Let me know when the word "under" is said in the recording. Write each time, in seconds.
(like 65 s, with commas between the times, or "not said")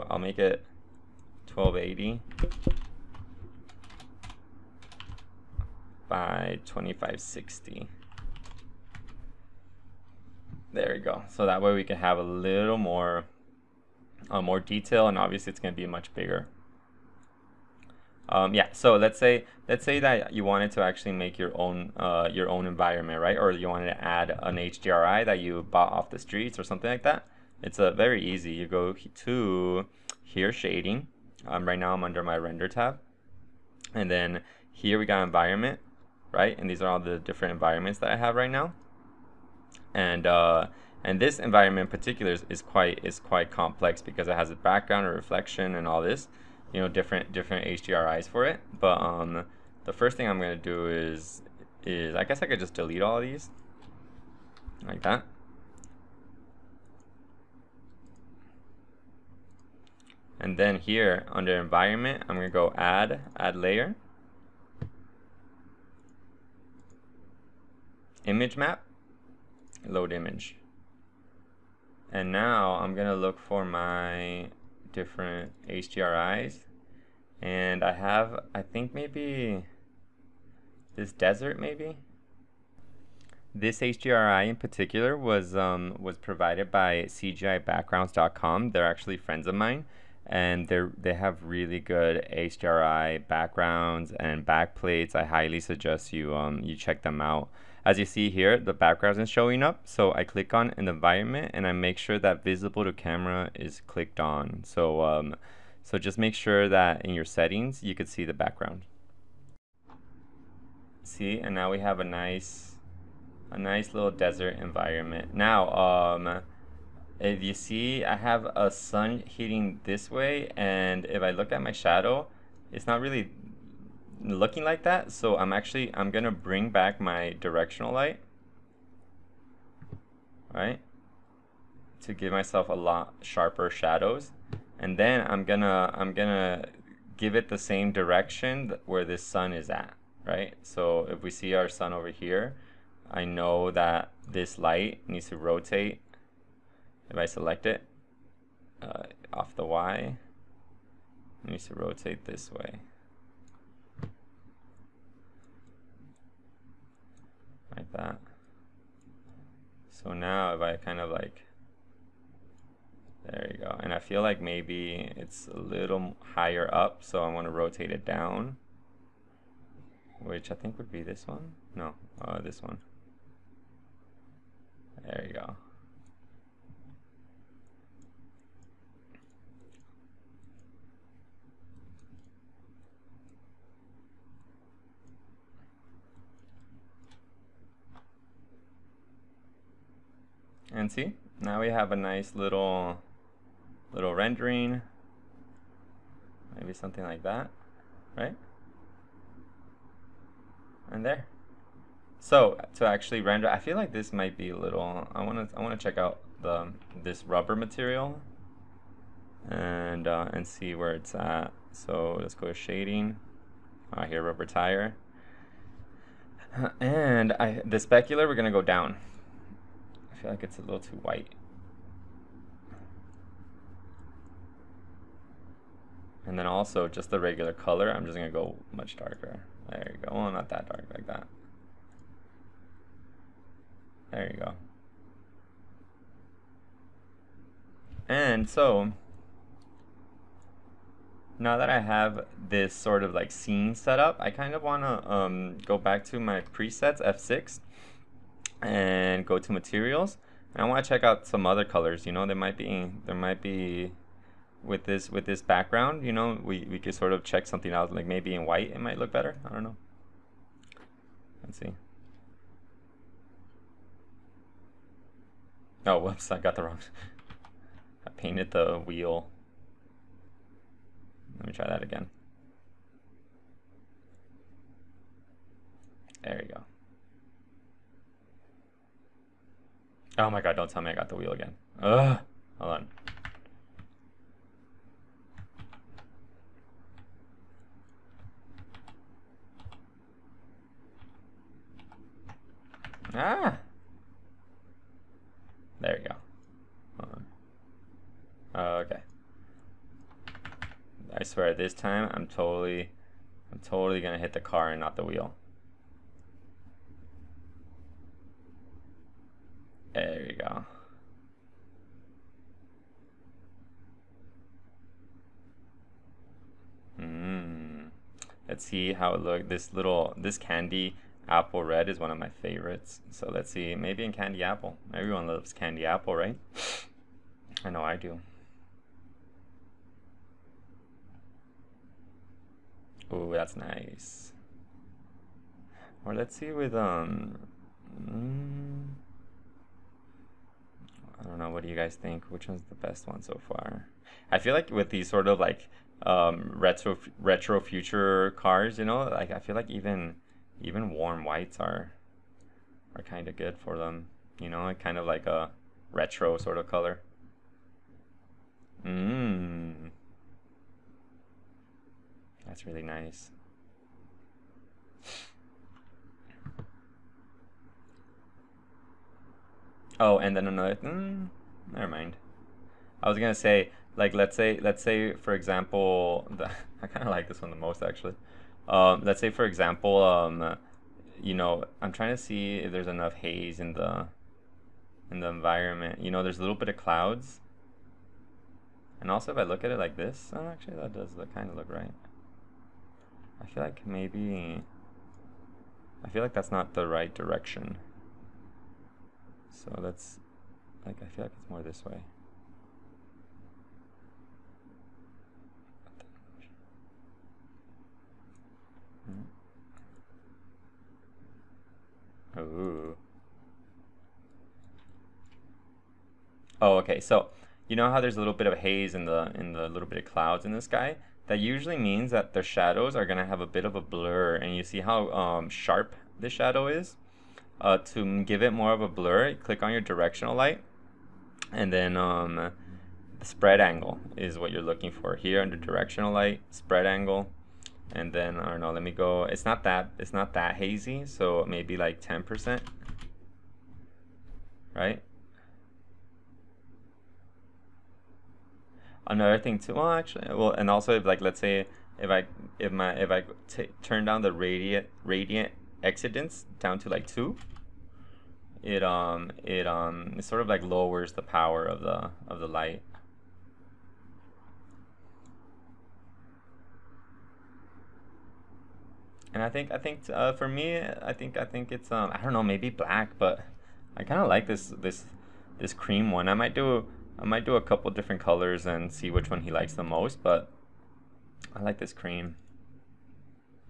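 32 s, 61 s, 435 s.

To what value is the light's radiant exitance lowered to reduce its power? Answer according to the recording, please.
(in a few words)
2.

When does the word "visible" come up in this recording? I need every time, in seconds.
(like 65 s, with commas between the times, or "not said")
102 s.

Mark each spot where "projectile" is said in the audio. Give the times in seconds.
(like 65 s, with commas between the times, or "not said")
not said.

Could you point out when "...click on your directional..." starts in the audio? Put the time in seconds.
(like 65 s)
429 s.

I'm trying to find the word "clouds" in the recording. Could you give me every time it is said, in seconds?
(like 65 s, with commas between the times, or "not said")
386 s, 420 s.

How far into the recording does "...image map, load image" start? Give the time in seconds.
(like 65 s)
68 s.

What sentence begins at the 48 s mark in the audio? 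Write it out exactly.
But um, the first thing I'm gonna do is is I guess I could just delete all these like that.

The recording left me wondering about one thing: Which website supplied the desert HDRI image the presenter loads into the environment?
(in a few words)
CGIBackgrounds.com.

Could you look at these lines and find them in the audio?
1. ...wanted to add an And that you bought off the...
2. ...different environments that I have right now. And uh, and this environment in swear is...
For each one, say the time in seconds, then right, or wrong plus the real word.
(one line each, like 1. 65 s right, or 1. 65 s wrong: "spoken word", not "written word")
1. 23 s wrong: "HDRI", not "And"
2. 37 s wrong: "particular", not "swear".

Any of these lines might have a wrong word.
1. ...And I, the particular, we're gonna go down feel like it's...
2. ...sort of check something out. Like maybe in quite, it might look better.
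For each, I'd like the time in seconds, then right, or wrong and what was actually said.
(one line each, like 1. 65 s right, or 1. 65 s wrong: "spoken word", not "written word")
1. 216 s wrong: "specular", not "particular"
2. 256 s wrong: "white", not "quite".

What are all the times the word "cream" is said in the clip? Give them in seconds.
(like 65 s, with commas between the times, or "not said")
475 s, 481 s.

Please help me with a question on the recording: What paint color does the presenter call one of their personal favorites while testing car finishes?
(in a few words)
candy apple red.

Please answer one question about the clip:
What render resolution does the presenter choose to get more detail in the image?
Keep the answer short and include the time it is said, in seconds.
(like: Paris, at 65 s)
1280 by 2560, at 1 s.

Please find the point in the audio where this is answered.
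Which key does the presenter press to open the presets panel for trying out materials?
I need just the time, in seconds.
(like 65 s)
247 s.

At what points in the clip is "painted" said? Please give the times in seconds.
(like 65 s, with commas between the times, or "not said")
268 s.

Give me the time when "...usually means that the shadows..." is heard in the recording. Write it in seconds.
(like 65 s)
421 s.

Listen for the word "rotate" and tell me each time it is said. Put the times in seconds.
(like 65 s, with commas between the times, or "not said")
145 s, 151 s, 167 s.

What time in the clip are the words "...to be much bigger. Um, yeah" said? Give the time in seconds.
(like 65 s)
15 s.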